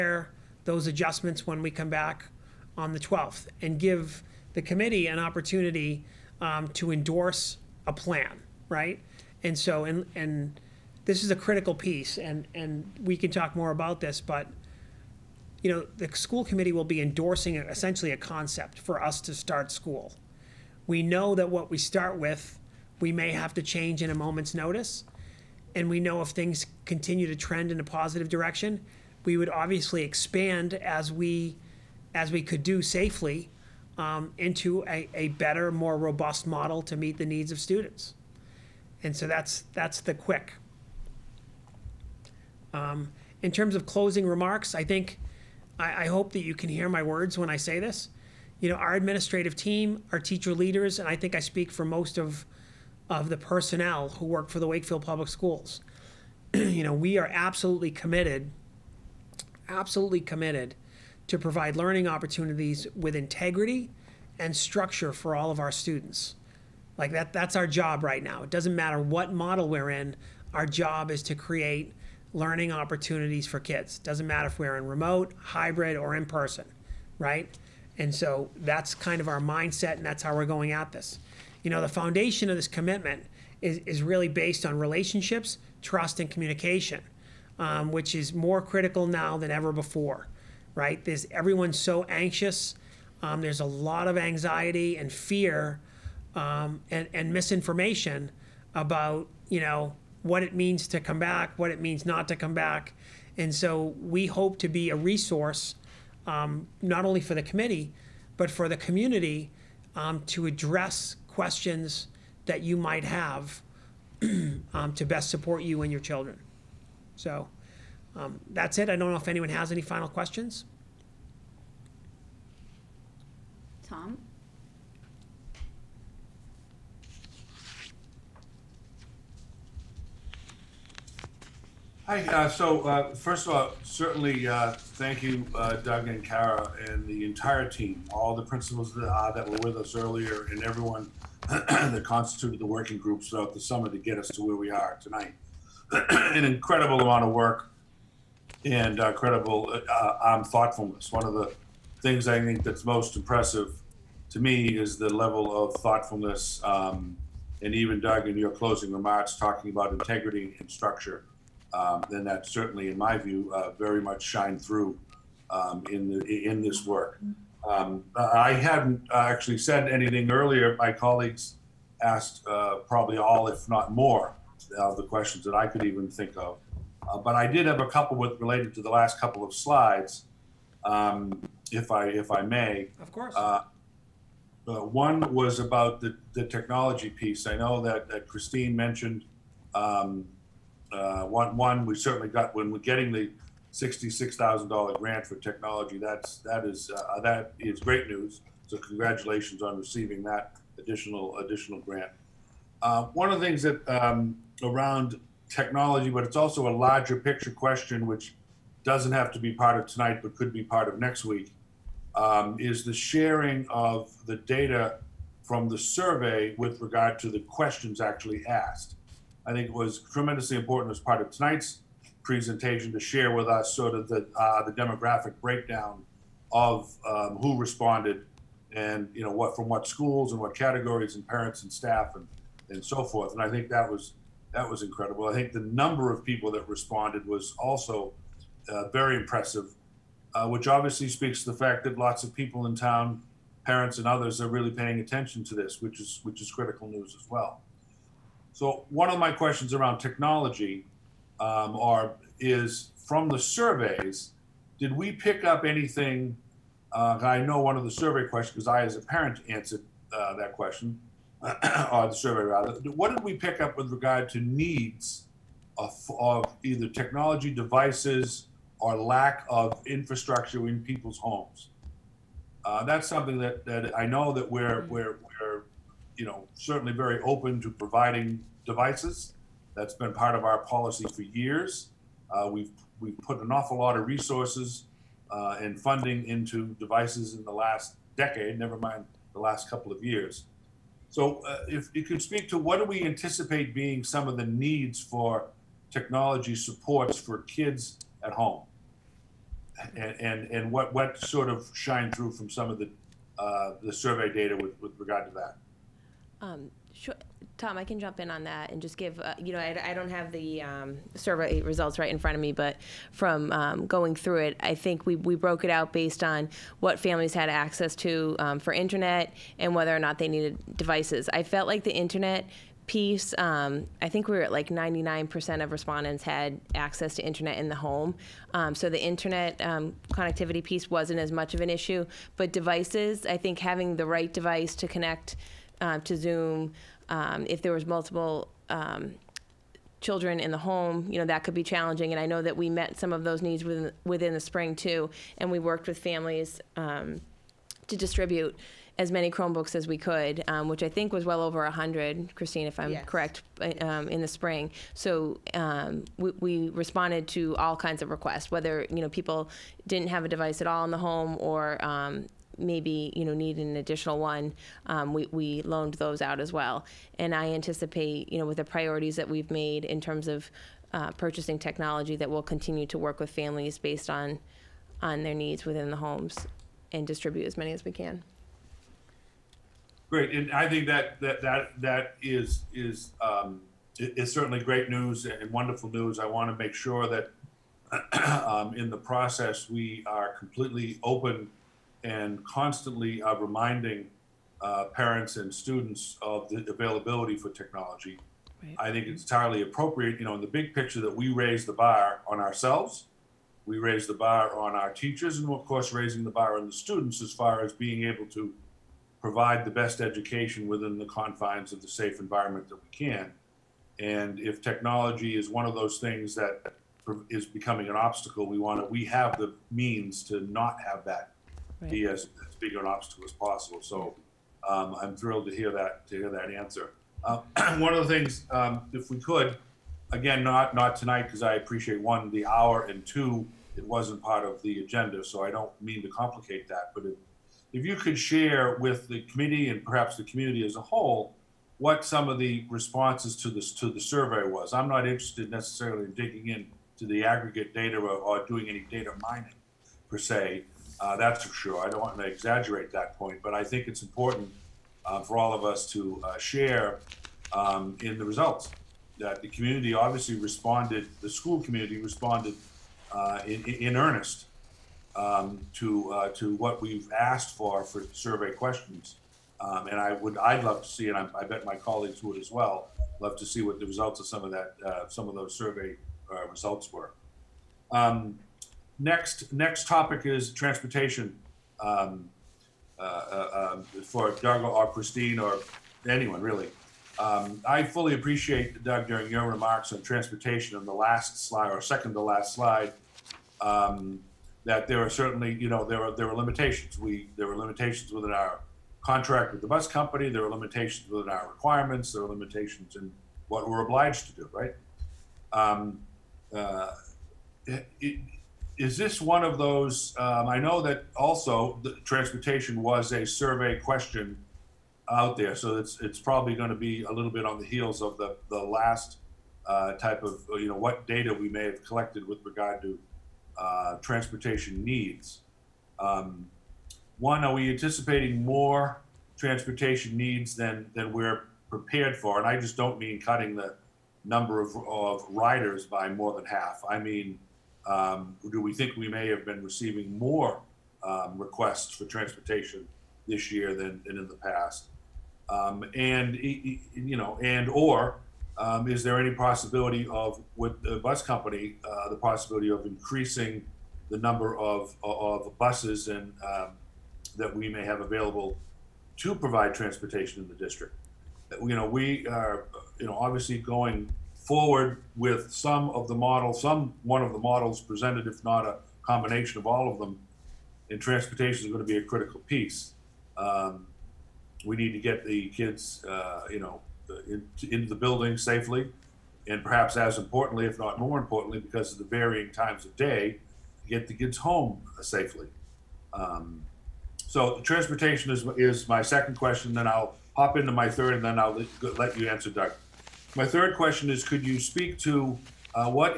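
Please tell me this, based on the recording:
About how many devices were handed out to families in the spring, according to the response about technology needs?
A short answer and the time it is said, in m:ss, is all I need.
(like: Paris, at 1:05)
over 100, at 5:51.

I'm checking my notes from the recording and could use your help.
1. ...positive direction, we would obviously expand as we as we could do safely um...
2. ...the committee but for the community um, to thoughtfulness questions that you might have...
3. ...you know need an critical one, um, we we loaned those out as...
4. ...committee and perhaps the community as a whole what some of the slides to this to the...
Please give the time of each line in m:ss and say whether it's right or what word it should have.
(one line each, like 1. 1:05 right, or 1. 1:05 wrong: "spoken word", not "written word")
1. 0:27 right
2. 1:47 wrong: "address", not "thoughtfulness"
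3. 6:03 wrong: "additional", not "critical"
4. 7:19 wrong: "responses", not "slides".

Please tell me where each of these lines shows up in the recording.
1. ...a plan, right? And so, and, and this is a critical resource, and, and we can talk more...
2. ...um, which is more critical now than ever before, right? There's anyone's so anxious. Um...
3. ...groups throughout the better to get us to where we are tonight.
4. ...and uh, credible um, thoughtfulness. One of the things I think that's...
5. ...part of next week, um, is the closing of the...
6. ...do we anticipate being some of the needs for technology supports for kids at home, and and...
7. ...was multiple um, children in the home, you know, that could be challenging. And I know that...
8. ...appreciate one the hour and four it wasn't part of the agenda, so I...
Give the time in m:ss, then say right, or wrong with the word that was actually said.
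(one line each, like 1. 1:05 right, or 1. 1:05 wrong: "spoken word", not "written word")
1. 0:07 wrong: "piece", not "resource"
2. 1:27 wrong: "everyone", not "anyone"
3. 2:22 wrong: "summer", not "better"
4. 2:28 right
5. 3:30 wrong: "sharing", not "closing"
6. 4:52 right
7. 5:37 right
8. 7:11 wrong: "two", not "four".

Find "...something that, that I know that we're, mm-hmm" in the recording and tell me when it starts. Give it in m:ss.
4:33.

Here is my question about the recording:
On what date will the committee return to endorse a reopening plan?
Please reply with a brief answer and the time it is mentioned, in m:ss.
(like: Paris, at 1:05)
the 12th, at 0:02.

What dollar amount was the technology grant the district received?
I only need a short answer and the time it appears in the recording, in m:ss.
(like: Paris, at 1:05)
$66,000, at 3:13.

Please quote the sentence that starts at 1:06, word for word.
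Like that that's our job right now.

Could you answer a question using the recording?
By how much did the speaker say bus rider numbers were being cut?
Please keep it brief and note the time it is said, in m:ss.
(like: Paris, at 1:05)
more than half, at 8:55.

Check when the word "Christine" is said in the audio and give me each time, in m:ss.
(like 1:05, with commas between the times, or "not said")
3:08, 5:52, 8:04.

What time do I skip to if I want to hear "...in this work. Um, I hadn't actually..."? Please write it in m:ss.
2:46.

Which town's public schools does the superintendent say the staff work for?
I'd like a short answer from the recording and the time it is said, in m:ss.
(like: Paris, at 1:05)
Wakefield, at 0:54.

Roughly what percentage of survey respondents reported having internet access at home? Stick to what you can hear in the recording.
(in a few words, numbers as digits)
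99%.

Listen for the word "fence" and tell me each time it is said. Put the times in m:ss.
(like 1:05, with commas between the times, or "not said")
not said.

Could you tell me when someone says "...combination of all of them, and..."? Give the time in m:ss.
9:29.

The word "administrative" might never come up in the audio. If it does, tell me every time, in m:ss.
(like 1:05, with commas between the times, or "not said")
0:48.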